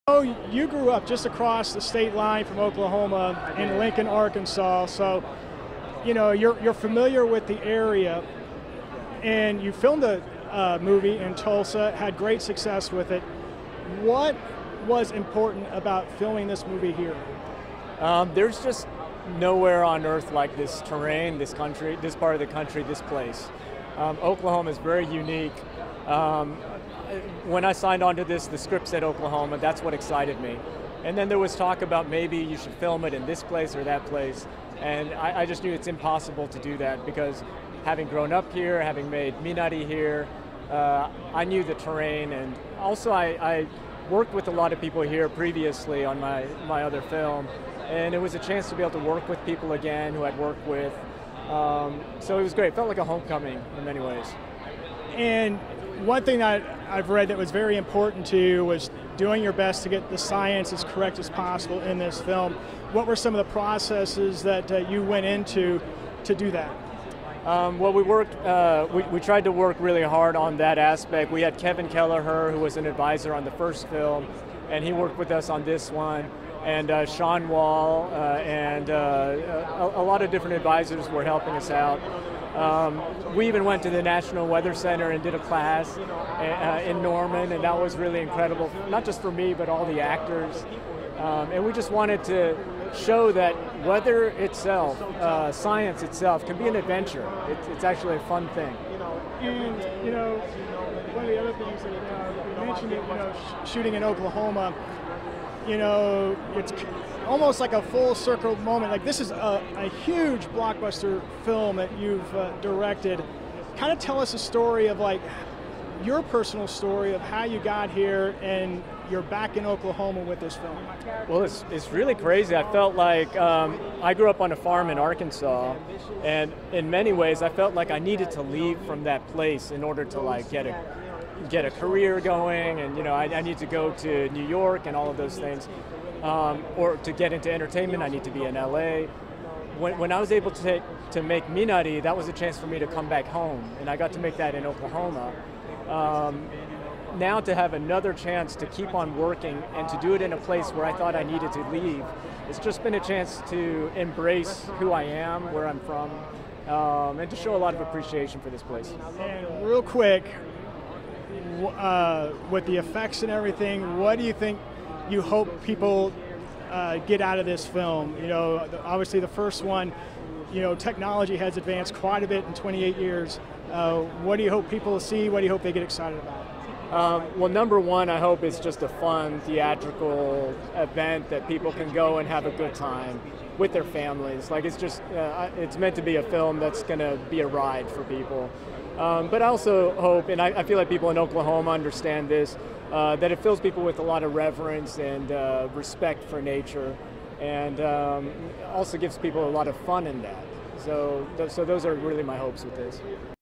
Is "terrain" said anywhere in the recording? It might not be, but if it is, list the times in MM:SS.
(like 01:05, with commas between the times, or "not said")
00:20, 00:41.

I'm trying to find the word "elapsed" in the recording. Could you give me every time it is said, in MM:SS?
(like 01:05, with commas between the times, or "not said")
not said.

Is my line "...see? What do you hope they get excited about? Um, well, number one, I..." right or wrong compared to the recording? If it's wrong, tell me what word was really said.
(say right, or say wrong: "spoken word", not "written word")
right.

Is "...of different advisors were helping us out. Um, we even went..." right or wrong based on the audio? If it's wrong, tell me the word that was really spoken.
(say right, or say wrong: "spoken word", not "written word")
right.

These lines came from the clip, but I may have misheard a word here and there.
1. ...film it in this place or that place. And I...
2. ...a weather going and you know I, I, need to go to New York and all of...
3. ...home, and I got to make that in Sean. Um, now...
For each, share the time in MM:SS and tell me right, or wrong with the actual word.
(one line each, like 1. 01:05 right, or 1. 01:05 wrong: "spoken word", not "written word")
1. 00:32 right
2. 02:11 wrong: "career", not "weather"
3. 02:23 wrong: "Oklahoma", not "Sean".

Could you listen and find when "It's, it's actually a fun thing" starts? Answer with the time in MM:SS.
01:37.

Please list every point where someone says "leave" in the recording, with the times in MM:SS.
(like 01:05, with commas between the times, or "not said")
02:08, 02:31.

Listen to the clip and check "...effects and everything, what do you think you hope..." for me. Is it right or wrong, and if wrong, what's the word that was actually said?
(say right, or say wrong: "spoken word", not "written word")
right.